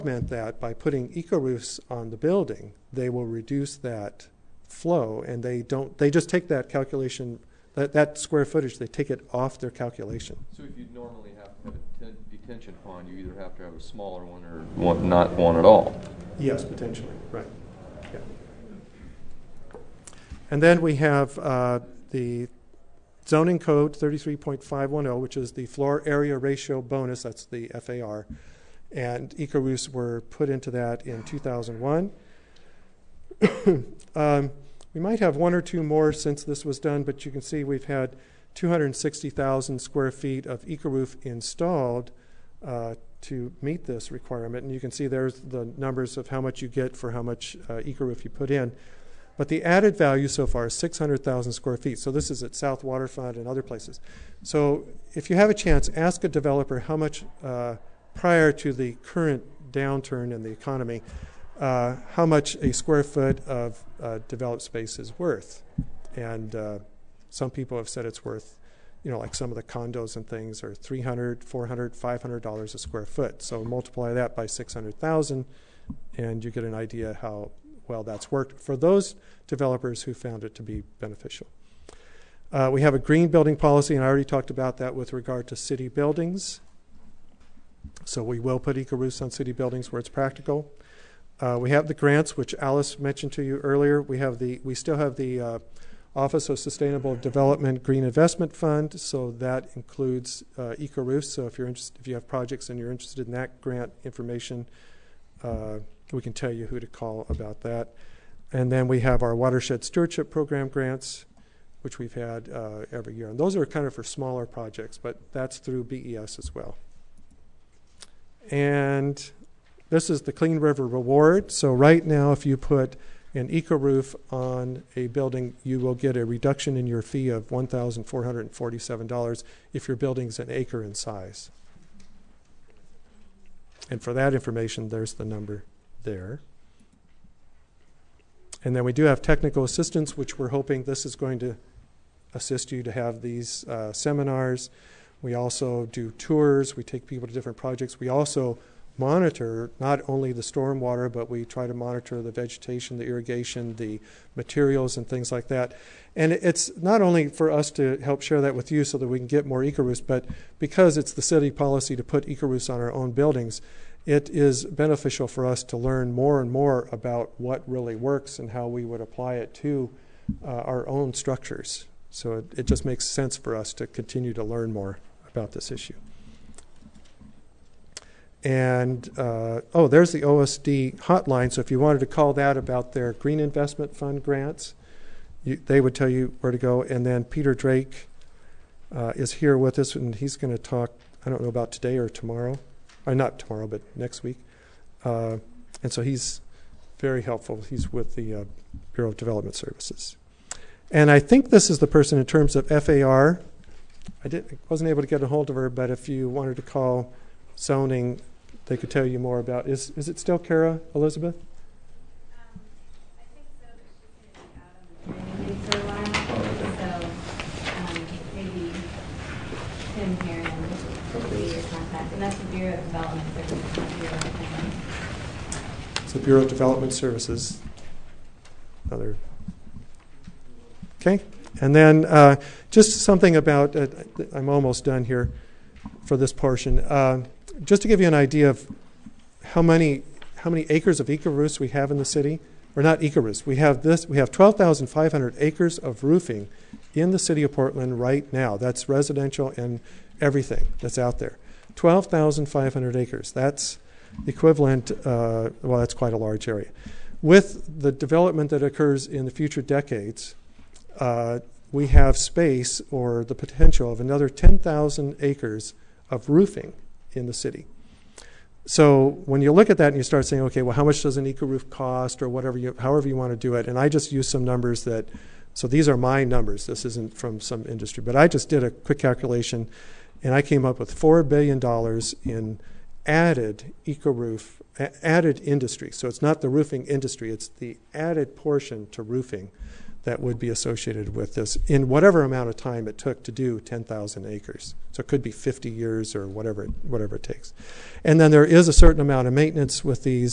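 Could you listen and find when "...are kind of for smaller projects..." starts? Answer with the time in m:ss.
1:53.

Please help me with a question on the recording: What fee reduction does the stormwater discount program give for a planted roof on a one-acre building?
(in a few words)
$1,447.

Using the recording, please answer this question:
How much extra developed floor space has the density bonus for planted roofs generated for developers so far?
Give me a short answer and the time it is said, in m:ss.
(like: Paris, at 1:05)
600,000 square feet, at 0:50.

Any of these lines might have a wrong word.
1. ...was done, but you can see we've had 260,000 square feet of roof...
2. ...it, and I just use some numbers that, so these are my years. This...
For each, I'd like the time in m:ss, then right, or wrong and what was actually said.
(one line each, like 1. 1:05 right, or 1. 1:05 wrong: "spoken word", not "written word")
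1. 0:36 right
2. 4:33 wrong: "numbers", not "years".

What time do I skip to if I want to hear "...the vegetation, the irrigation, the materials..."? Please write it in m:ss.
2:32.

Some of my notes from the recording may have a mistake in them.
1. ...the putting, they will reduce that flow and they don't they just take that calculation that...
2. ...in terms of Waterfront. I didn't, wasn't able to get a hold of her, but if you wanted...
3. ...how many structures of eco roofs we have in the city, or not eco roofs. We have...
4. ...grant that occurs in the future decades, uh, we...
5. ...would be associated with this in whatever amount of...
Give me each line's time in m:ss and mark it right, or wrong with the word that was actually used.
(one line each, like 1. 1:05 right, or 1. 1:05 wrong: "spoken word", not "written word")
1. 0:02 wrong: "building", not "putting"
2. 3:22 wrong: "FAR", not "Waterfront"
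3. 4:00 wrong: "acres", not "structures"
4. 4:17 wrong: "development", not "grant"
5. 4:50 right.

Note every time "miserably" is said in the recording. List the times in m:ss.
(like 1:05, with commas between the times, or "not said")
not said.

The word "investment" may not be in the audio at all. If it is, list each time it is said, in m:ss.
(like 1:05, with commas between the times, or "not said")
1:38, 3:03.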